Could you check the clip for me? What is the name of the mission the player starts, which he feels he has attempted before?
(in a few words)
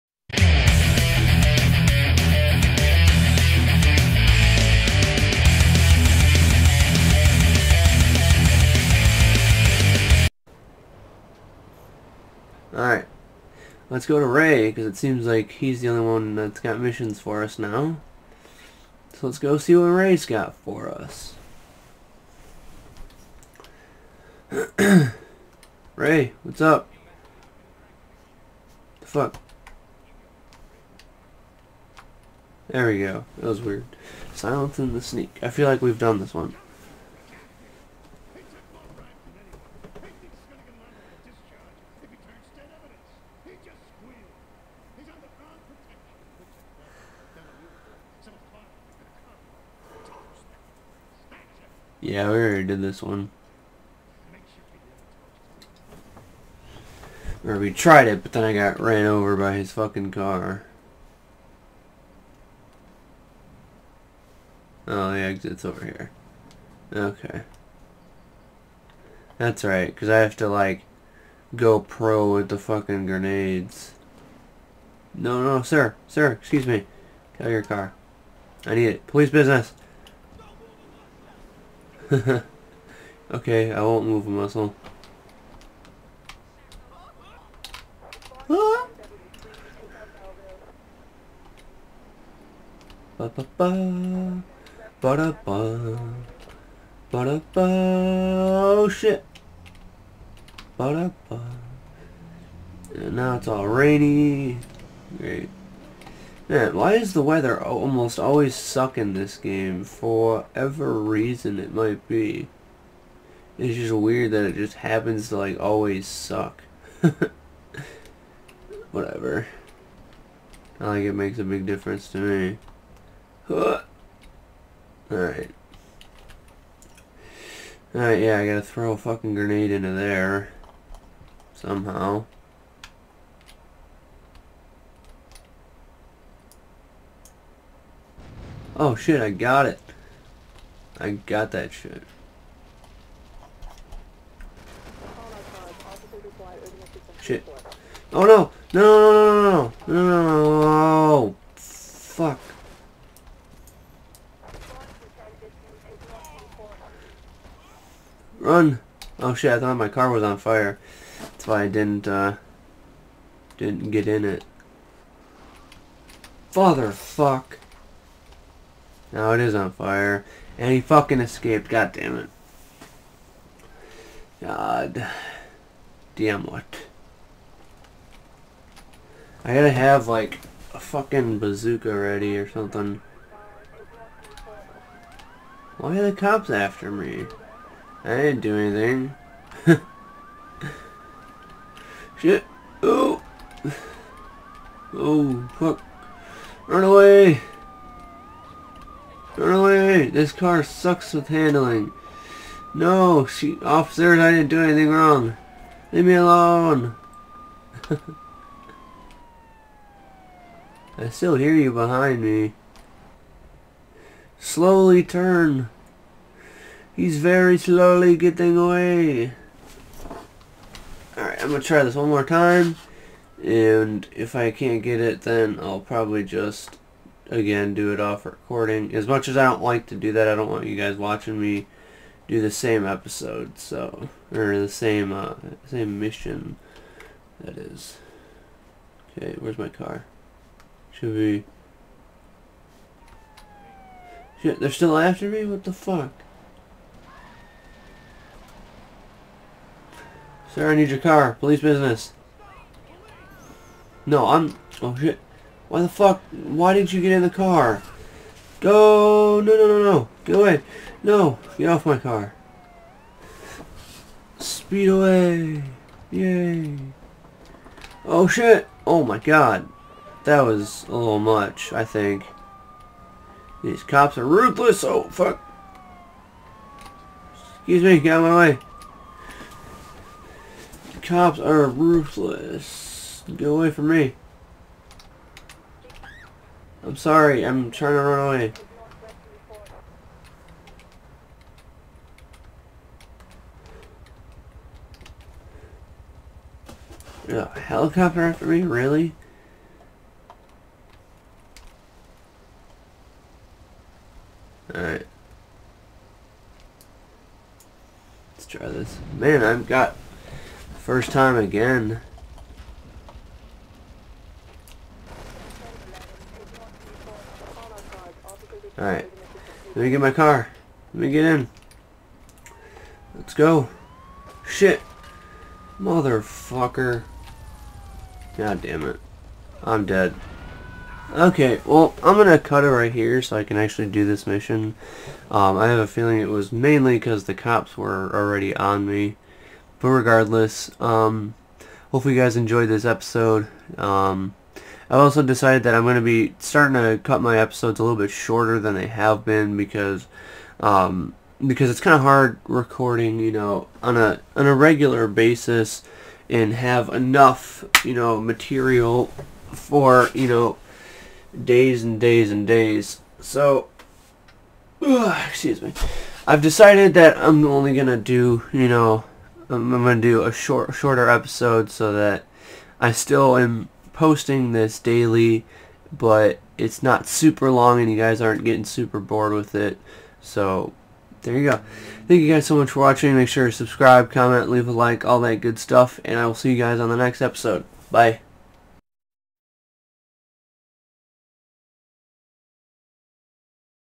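Silence and the Sneak.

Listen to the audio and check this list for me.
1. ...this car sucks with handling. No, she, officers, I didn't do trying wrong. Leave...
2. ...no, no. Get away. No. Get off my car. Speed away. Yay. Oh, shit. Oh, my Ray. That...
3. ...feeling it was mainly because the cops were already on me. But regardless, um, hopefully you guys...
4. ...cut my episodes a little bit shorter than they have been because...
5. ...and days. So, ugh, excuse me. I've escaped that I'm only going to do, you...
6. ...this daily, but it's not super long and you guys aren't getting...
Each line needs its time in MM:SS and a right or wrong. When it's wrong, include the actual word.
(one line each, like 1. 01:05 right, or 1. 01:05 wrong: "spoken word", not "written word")
1. 03:20 wrong: "anything", not "trying"
2. 04:19 wrong: "God", not "Ray"
3. 05:35 right
4. 05:47 right
5. 06:02 wrong: "decided", not "escaped"
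6. 06:14 right.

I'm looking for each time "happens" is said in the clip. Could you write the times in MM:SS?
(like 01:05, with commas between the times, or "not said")
01:54.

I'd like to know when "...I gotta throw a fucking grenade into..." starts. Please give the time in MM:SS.
02:08.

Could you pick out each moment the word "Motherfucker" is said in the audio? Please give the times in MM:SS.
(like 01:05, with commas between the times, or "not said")
05:25.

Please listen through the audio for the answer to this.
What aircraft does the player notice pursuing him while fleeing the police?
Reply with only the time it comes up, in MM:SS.
04:57.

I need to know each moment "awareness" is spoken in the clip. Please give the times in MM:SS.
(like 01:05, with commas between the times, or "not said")
not said.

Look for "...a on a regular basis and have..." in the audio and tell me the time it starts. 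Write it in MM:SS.
05:53.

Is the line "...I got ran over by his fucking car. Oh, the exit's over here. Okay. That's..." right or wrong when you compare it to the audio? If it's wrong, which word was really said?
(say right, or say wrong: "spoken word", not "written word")
right.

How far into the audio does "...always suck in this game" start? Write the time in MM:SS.
01:48.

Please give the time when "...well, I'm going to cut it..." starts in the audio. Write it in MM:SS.
05:31.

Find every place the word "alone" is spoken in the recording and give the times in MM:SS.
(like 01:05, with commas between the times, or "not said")
03:26.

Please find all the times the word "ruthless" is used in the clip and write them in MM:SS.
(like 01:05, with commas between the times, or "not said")
04:34, 04:41.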